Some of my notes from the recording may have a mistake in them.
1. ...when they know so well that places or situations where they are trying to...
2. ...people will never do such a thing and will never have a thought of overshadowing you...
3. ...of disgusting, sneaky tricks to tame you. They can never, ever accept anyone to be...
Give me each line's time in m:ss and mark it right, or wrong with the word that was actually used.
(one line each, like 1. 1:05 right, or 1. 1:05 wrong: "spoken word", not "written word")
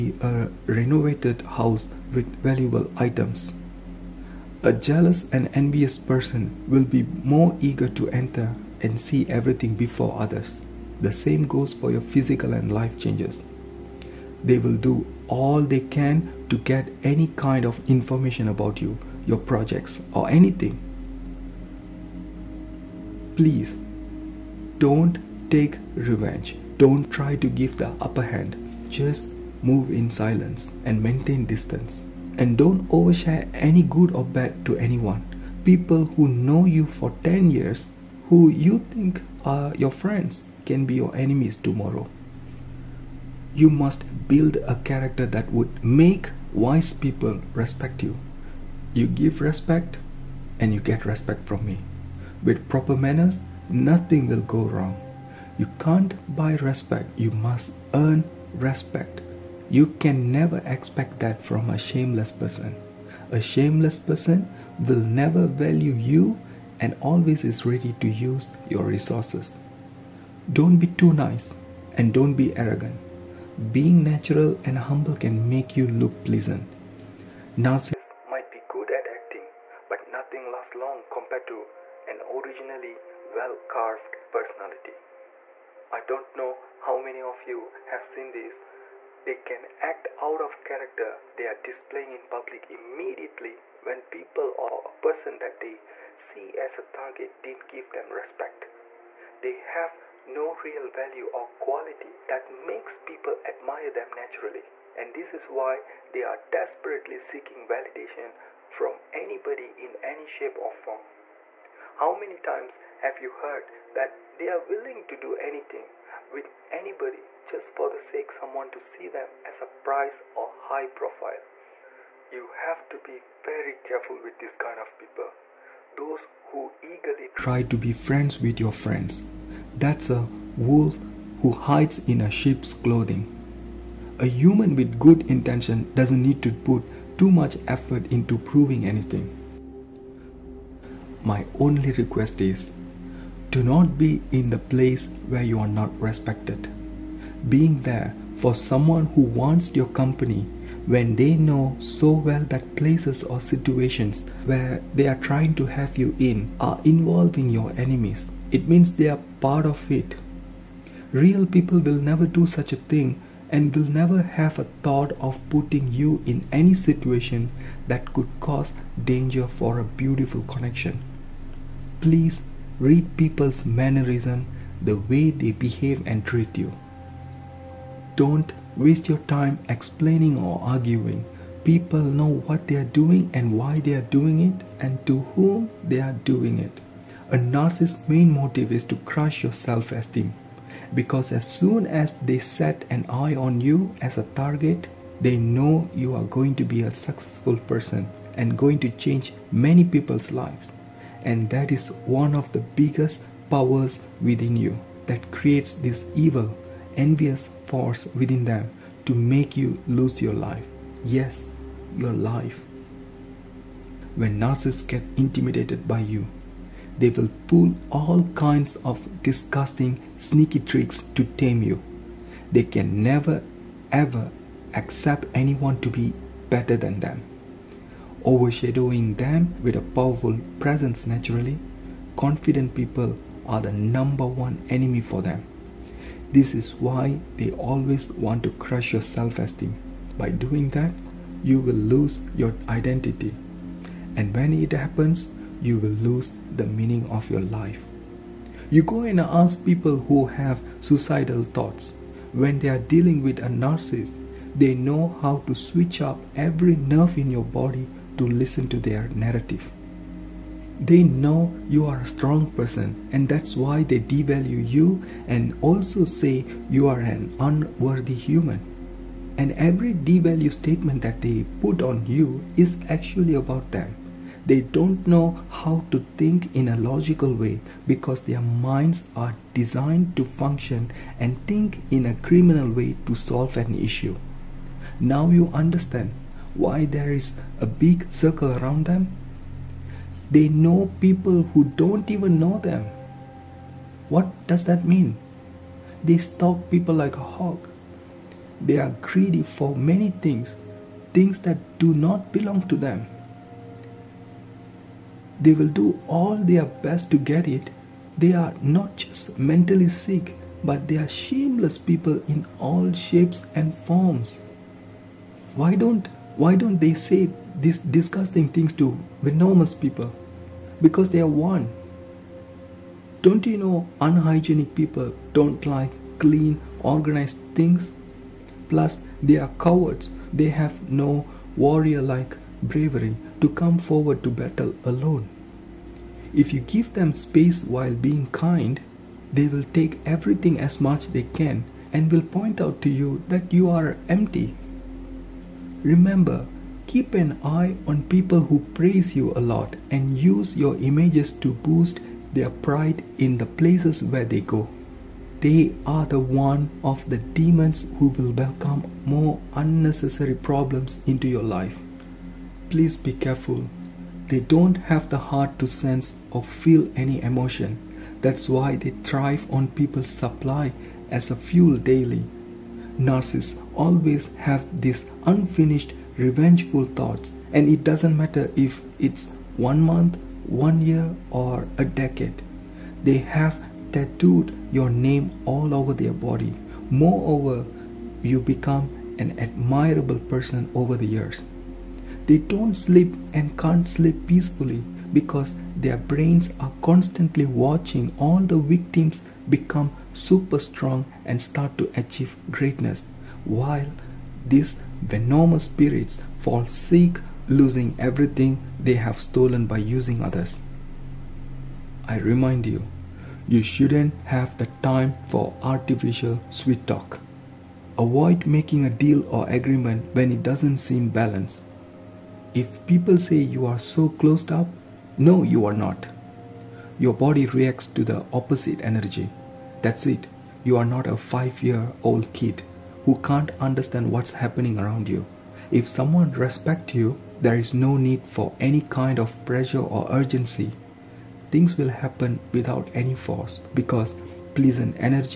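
1. 2:30 right
2. 2:41 wrong: "putting", not "overshadowing"
3. 3:38 right.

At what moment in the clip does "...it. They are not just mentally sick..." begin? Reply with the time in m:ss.
5:07.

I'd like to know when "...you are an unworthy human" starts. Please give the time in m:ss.
4:26.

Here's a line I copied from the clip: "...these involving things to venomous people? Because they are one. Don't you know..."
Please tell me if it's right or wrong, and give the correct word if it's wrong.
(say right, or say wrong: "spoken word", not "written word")
wrong: "disgusting", not "involving".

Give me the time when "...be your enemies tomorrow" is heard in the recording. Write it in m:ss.
0:40.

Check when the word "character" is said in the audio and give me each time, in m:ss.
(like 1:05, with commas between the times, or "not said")
0:44, 1:30.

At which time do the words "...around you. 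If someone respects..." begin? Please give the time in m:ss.
7:14.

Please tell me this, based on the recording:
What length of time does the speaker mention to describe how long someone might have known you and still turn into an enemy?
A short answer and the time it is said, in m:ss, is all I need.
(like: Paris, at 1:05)
10 years, at 0:37.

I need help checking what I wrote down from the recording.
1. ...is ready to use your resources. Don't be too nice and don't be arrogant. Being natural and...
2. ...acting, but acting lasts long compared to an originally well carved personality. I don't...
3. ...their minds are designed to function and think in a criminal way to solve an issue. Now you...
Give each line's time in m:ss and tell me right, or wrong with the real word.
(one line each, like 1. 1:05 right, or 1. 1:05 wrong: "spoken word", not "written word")
1. 1:07 right
2. 1:19 wrong: "nothing", not "acting"
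3. 4:38 right.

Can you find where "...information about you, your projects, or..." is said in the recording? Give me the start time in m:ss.
0:17.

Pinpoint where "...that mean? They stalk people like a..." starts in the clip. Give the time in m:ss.
4:54.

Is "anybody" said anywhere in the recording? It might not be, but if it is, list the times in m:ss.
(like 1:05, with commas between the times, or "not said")
1:49, 1:56.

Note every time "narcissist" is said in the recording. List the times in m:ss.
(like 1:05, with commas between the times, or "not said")
1:17, 3:07, 3:34, 4:13, 6:12.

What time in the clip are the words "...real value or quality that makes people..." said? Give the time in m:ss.
1:40.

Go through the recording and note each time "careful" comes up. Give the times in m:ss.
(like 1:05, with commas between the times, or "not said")
2:03, 6:03.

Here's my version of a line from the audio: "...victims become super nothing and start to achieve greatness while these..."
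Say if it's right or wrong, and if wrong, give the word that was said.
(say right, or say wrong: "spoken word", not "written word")
wrong: "strong", not "nothing".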